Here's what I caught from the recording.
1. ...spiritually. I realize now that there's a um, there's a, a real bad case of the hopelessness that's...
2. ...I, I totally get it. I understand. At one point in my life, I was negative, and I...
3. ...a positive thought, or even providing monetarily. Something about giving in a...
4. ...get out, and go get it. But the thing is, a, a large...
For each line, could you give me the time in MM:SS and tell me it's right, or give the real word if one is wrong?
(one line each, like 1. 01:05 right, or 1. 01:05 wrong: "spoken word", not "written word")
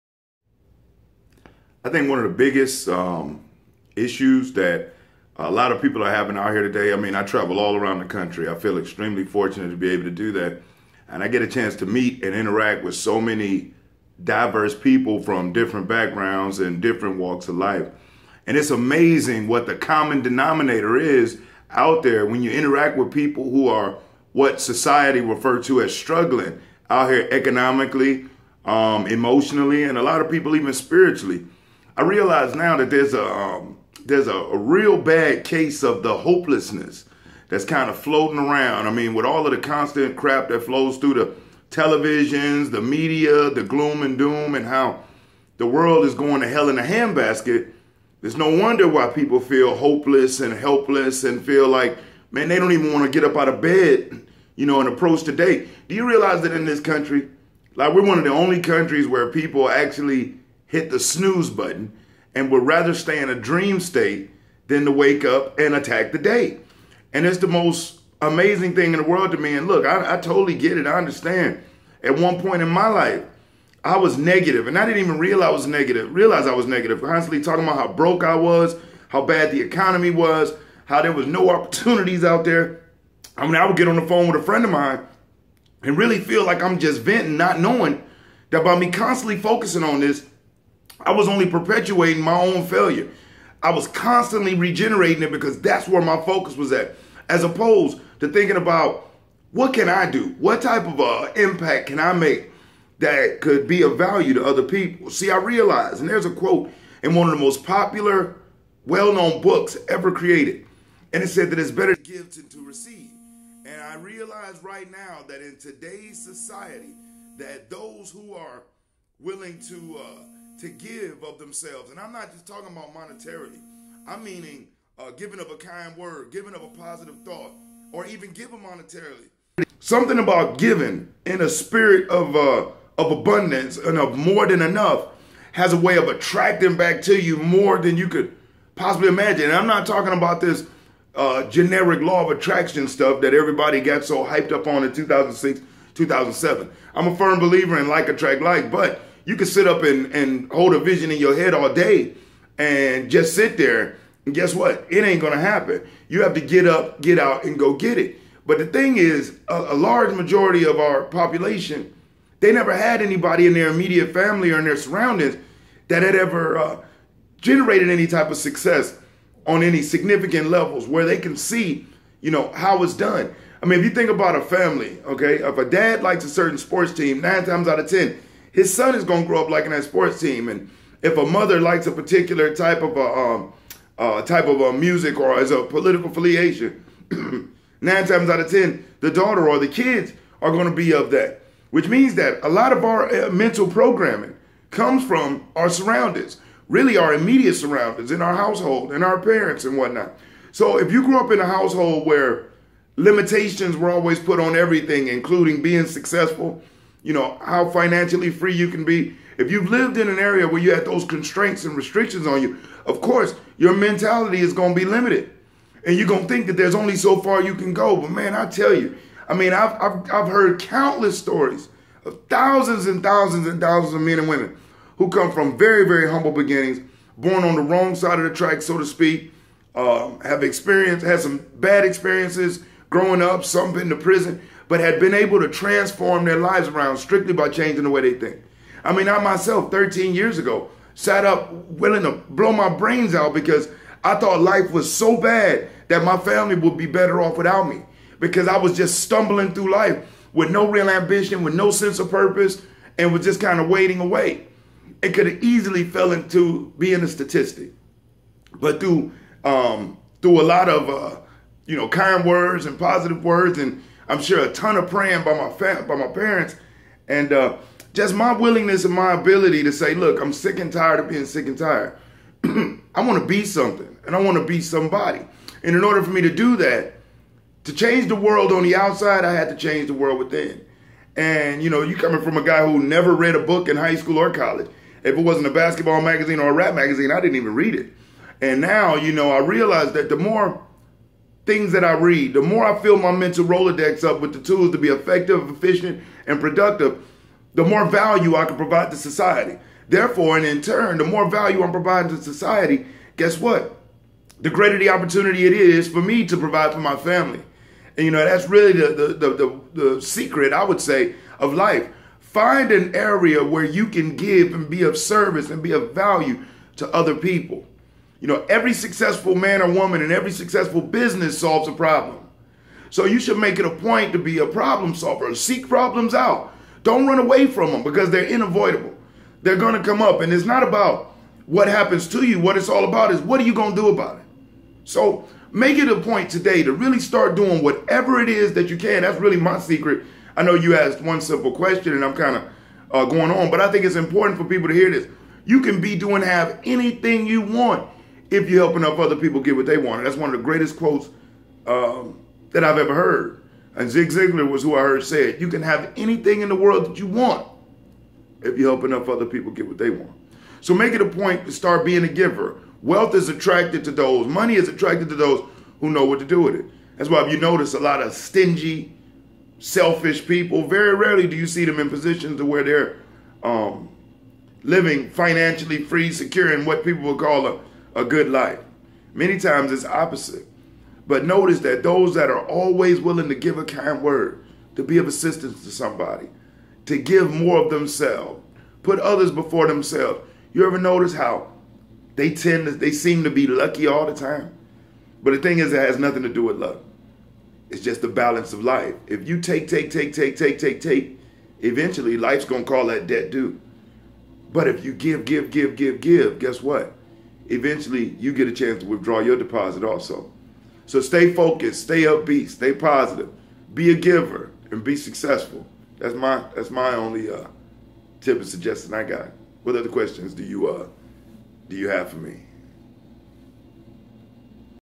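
1. 00:30 right
2. 01:09 right
3. 02:06 wrong: "giving", not "providing"
4. 02:37 right.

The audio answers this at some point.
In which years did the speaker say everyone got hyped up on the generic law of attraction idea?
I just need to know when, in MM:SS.
02:24.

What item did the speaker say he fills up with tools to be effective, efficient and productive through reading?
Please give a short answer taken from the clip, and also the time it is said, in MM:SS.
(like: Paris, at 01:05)
Mental Rolodex, at 04:53.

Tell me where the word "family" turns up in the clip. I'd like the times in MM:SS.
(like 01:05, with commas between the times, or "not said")
02:44, 02:54, 04:06, 05:06.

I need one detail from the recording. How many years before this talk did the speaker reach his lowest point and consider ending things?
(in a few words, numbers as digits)
13.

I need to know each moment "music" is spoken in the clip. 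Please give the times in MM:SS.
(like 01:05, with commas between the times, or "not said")
03:04.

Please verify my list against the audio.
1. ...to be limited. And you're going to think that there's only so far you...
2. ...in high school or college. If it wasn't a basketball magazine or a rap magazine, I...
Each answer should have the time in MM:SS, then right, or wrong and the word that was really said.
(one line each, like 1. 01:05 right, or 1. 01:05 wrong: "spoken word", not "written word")
1. 03:34 right
2. 04:43 right.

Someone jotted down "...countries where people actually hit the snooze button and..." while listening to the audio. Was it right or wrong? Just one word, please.
right.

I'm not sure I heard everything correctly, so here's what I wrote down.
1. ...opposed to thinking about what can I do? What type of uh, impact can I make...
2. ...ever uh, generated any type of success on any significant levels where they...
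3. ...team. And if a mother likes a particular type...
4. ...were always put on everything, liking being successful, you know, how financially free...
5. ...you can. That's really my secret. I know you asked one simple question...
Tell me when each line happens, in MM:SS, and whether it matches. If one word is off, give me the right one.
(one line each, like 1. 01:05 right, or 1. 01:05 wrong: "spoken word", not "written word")
1. 01:37 right
2. 02:46 right
3. 03:00 right
4. 03:23 wrong: "including", not "liking"
5. 05:38 right.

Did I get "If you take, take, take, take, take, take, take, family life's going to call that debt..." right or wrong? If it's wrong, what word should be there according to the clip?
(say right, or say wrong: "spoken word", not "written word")
wrong: "eventually", not "family".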